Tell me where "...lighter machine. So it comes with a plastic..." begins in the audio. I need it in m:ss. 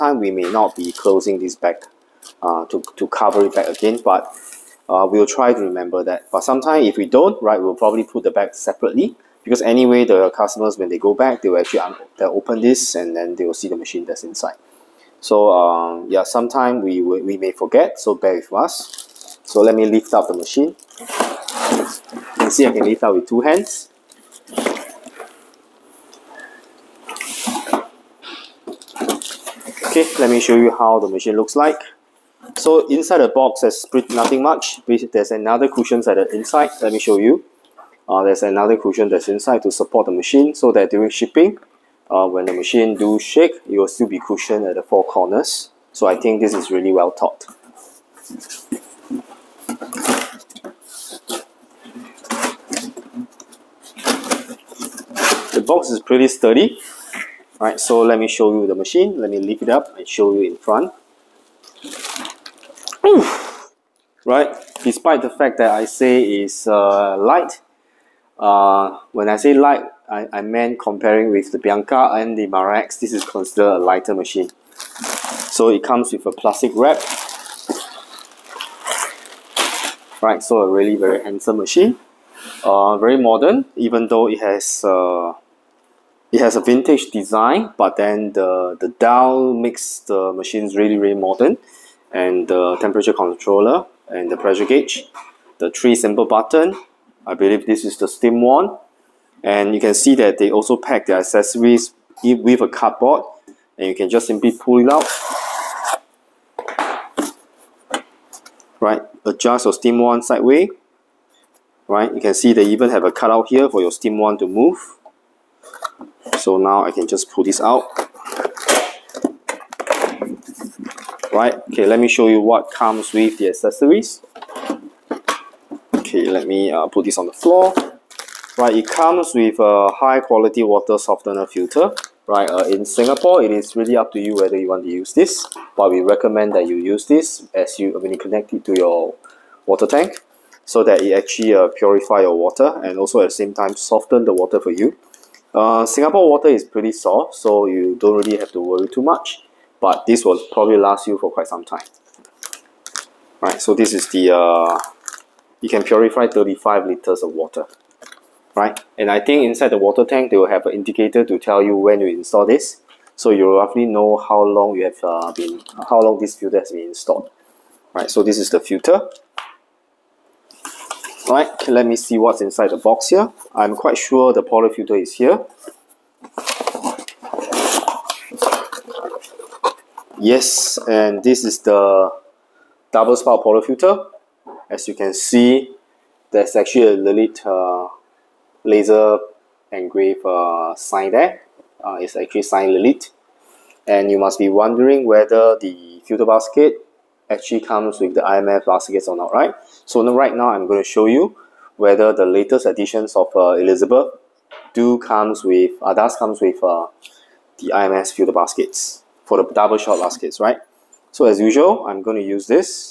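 1:13.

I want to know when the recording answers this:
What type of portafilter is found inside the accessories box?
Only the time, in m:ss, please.
3:02.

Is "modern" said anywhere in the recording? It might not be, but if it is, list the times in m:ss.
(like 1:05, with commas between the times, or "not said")
1:23, 1:31.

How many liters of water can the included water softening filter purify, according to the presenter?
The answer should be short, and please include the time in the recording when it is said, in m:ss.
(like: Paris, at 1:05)
35, at 2:36.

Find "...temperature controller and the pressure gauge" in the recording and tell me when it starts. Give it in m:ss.
1:32.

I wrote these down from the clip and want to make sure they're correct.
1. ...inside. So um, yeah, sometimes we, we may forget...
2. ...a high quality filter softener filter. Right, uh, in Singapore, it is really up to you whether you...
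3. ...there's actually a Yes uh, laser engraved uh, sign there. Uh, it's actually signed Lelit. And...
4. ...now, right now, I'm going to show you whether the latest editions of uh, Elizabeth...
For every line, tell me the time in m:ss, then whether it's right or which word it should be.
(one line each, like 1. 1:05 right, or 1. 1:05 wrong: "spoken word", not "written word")
1. 0:14 right
2. 2:09 wrong: "water", not "filter"
3. 3:06 wrong: "Lelit", not "Yes"
4. 3:20 right.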